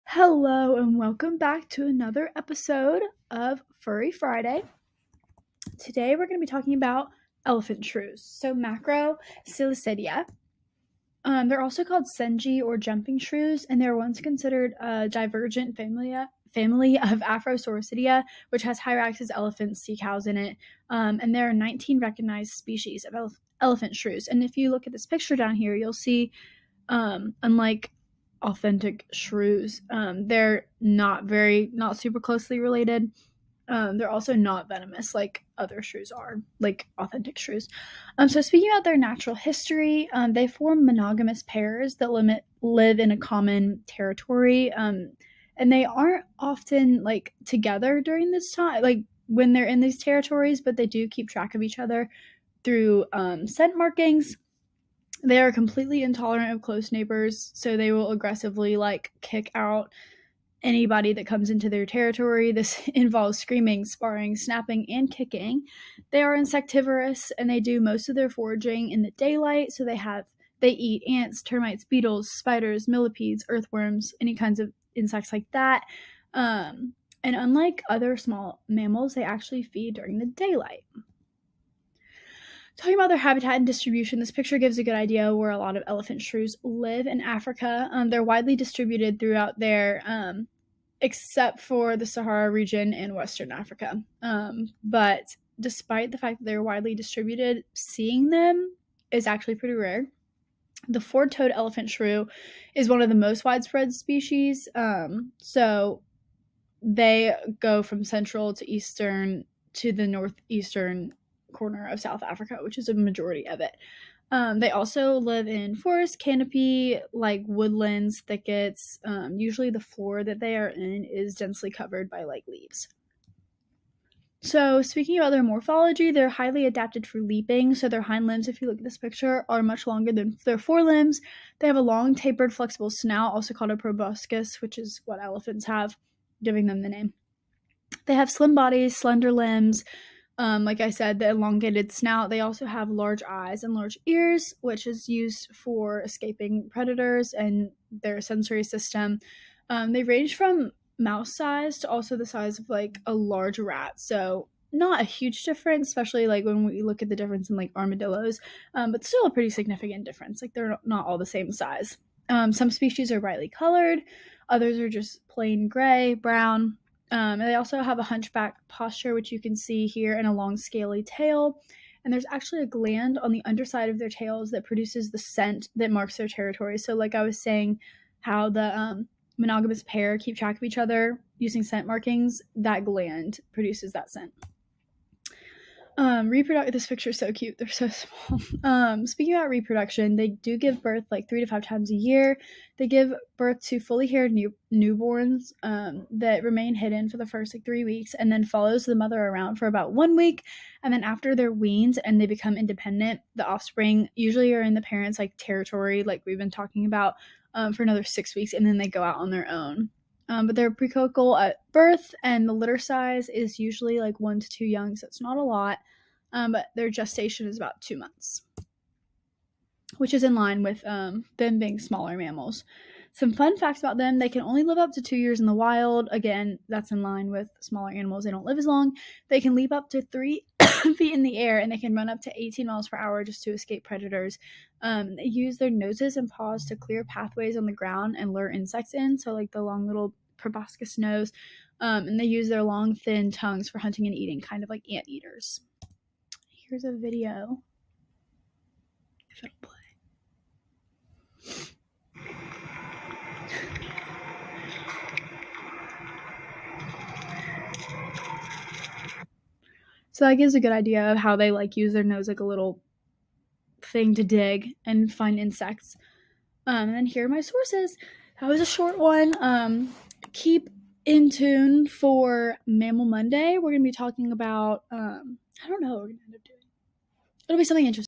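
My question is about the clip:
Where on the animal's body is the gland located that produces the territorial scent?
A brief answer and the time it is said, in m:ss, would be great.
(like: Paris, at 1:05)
underside of their tails, at 2:53.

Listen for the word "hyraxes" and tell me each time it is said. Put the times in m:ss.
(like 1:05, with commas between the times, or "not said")
0:18.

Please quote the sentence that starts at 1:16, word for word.
Um, and unlike other small mammals, they actually feed during the daylight.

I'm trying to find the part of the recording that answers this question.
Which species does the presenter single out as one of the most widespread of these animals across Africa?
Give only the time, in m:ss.
1:41.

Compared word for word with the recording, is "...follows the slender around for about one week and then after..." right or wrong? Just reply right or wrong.
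wrong.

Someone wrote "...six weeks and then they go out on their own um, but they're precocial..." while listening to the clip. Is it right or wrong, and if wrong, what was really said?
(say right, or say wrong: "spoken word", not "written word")
right.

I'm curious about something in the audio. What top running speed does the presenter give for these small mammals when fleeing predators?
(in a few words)
18 miles per hour.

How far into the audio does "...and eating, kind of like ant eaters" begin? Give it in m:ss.
4:04.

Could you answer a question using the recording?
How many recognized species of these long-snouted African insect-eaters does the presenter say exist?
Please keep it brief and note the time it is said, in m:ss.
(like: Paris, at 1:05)
19, at 0:21.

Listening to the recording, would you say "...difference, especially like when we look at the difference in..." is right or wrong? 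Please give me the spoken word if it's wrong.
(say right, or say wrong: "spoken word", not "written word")
right.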